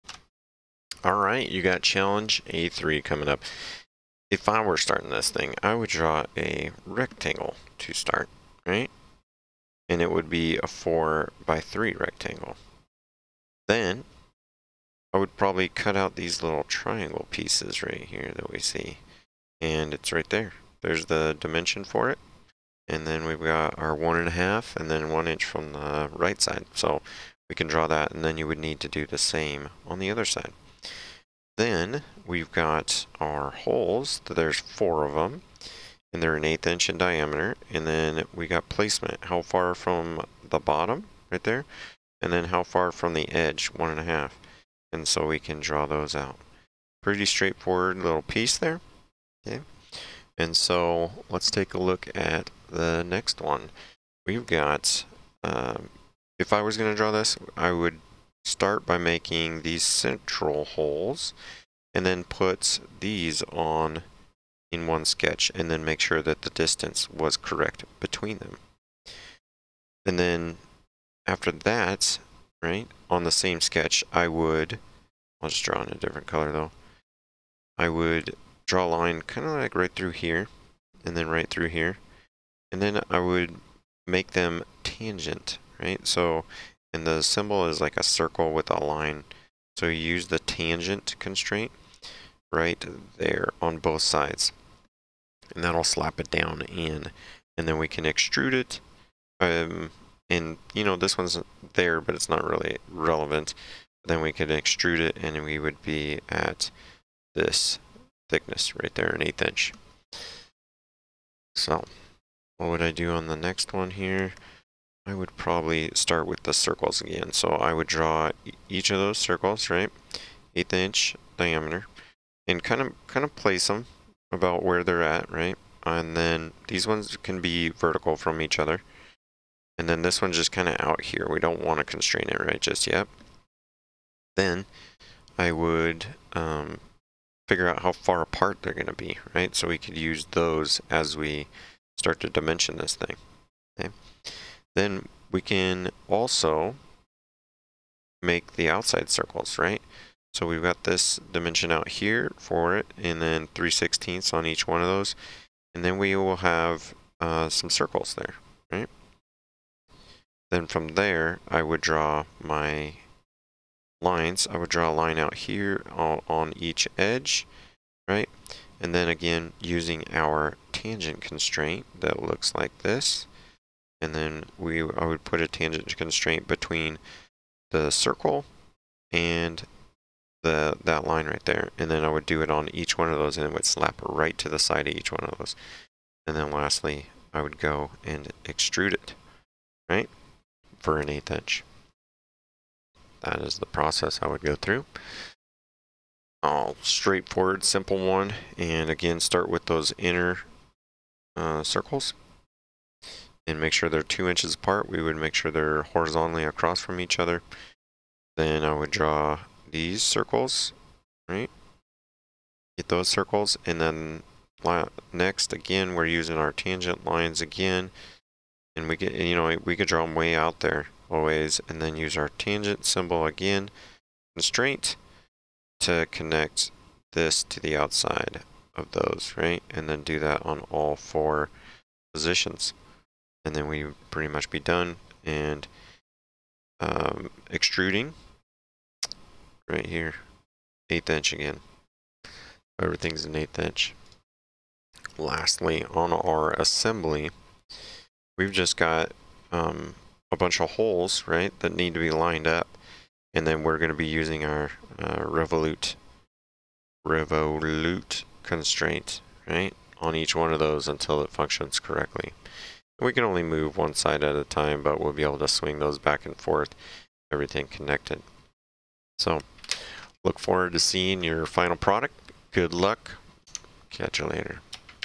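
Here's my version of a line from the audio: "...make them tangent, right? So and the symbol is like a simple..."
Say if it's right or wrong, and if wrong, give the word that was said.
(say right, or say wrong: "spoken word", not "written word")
wrong: "circle", not "simple".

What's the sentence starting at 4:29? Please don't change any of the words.
So look forward to seeing your final product.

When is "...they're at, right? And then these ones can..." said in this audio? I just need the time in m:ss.
2:04.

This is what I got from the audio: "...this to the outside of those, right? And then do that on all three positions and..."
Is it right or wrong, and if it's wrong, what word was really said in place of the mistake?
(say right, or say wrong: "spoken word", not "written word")
wrong: "four", not "three".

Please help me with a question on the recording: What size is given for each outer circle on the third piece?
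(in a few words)
3/16.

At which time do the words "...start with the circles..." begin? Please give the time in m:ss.
1:55.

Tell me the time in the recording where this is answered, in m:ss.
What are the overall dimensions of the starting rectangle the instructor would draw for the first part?
0:10.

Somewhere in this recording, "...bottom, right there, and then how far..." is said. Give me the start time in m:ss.
0:40.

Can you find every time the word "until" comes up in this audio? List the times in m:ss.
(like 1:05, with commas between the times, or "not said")
4:20.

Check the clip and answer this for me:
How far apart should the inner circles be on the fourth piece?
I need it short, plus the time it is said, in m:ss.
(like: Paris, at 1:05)
2 inches, at 3:24.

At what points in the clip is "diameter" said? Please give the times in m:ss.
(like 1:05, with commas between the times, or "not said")
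0:36, 2:01.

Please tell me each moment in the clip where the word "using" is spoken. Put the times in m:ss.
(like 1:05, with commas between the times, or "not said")
2:49, 3:36, 4:14.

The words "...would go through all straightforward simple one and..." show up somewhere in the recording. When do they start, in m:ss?
3:14.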